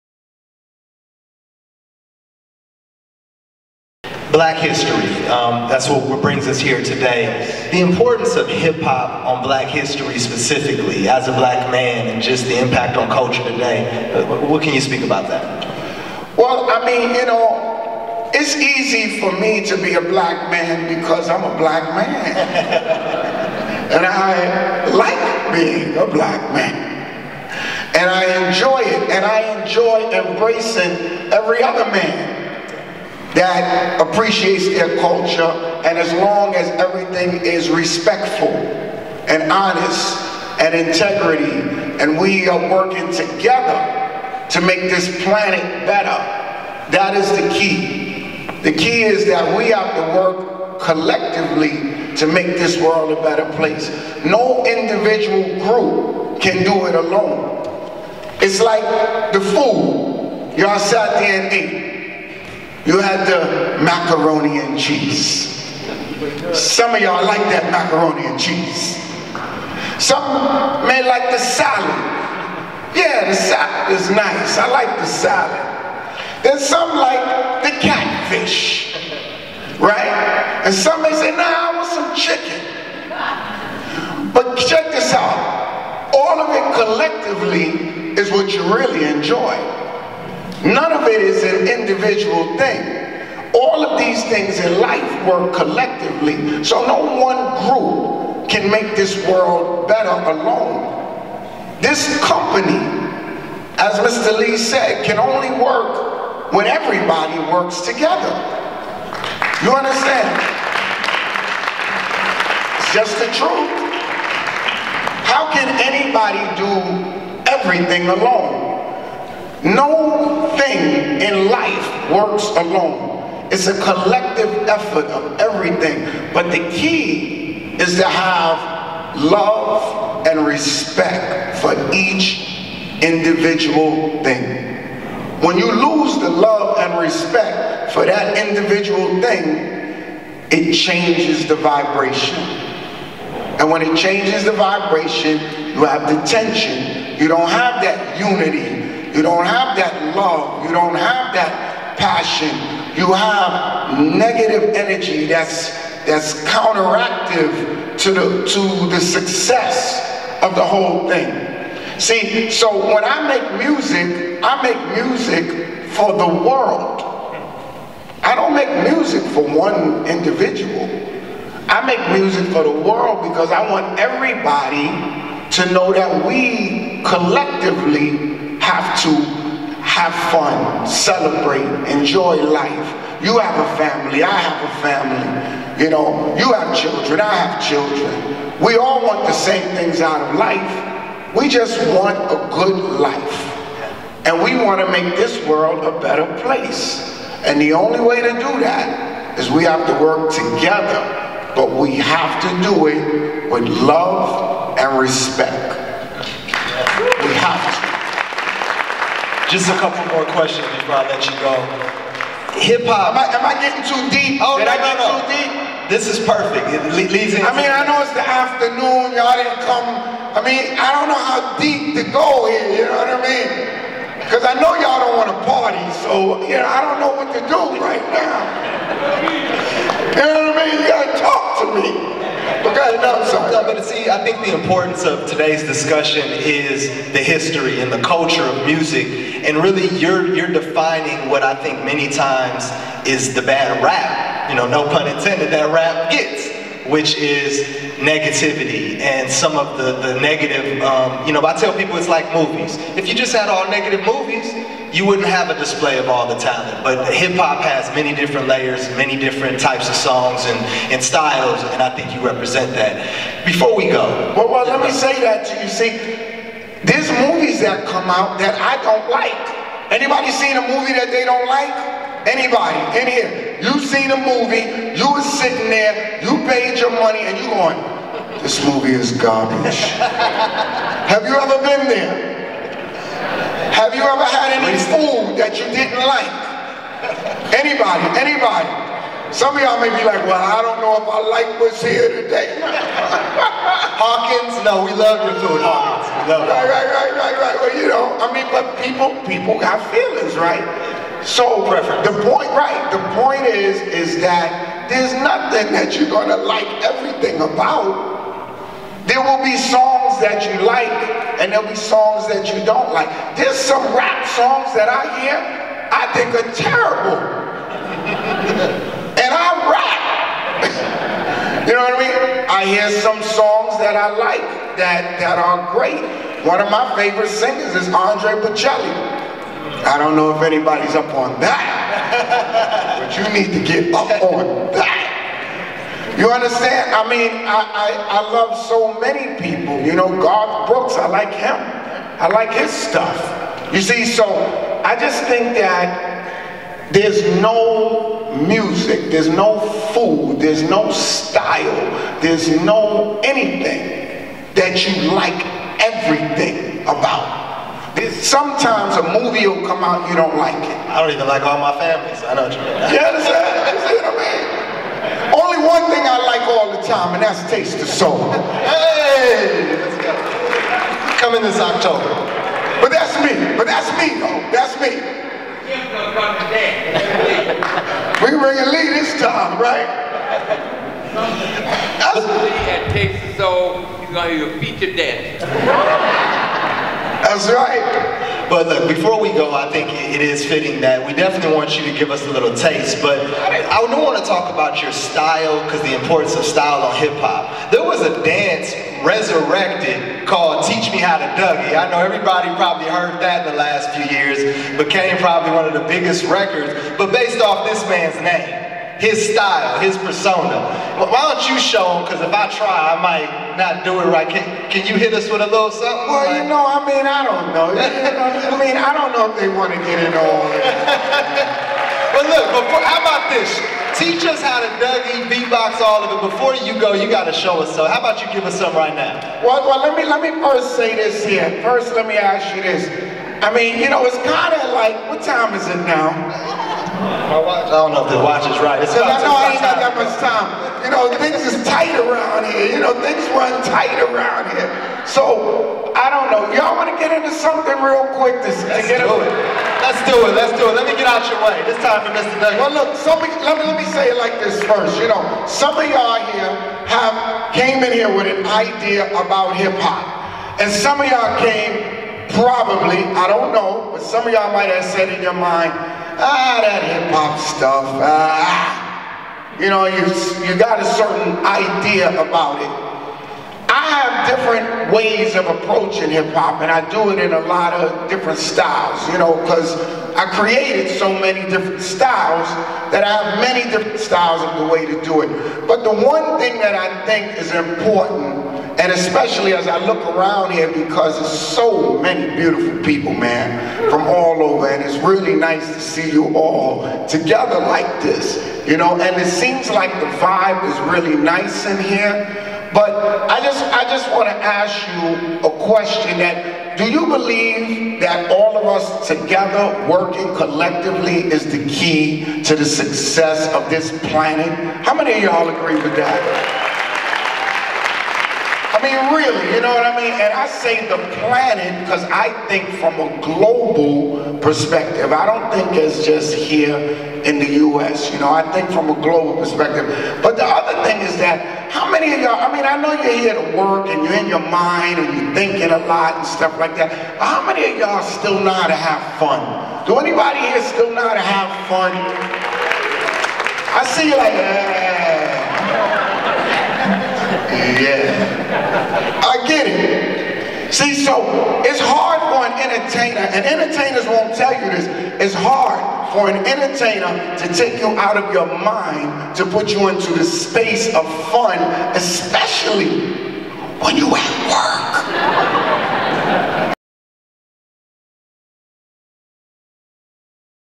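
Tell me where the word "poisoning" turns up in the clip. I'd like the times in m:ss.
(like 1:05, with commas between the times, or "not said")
not said.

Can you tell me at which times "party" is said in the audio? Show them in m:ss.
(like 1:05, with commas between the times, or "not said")
3:45.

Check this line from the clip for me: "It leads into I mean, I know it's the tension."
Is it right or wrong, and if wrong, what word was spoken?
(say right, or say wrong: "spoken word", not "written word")
wrong: "afternoon", not "tension".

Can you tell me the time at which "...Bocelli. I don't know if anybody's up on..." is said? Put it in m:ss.
5:28.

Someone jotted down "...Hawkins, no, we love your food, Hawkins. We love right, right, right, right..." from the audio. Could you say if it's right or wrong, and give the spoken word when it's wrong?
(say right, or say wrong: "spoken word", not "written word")
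right.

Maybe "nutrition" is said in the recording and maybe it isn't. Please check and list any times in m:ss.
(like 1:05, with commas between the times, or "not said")
not said.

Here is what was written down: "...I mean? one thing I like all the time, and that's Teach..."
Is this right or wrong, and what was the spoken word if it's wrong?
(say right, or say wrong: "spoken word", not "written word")
wrong: "Taste", not "Teach".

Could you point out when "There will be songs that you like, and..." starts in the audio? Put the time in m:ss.
5:09.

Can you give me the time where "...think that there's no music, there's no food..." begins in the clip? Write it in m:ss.
5:45.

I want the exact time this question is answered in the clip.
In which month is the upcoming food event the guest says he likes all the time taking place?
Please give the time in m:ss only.
6:11.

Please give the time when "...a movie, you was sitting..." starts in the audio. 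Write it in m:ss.
4:34.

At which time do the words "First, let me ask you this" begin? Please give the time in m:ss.
7:11.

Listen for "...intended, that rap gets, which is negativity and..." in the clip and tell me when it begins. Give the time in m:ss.
4:05.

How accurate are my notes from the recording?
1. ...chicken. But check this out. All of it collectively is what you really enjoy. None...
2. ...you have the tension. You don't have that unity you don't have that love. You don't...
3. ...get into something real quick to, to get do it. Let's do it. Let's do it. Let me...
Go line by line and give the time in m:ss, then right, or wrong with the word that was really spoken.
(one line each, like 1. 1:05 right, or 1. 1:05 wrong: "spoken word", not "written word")
1. 1:22 right
2. 2:25 right
3. 7:27 right.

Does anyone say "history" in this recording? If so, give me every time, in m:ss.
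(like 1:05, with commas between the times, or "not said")
0:04, 0:09, 3:57.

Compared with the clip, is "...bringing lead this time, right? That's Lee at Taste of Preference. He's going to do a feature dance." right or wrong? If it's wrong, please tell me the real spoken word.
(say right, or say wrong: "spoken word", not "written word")
wrong: "Soul", not "Preference".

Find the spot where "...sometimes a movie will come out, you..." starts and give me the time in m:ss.
5:58.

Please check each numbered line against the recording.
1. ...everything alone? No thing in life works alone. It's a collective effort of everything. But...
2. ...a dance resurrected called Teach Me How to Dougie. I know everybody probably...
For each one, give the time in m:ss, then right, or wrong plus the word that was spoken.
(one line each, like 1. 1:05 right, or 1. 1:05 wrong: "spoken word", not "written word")
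1. 1:57 right
2. 6:38 right.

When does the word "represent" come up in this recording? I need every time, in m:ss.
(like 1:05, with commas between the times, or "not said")
4:22.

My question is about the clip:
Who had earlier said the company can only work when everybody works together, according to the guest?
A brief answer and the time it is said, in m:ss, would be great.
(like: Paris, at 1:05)
Mr. Lee, at 1:44.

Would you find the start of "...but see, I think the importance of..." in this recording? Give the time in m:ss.
3:53.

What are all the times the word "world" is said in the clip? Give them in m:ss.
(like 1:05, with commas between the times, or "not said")
0:52, 1:39, 2:46, 2:52, 3:15.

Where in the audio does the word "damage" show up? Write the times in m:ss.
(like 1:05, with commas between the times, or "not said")
not said.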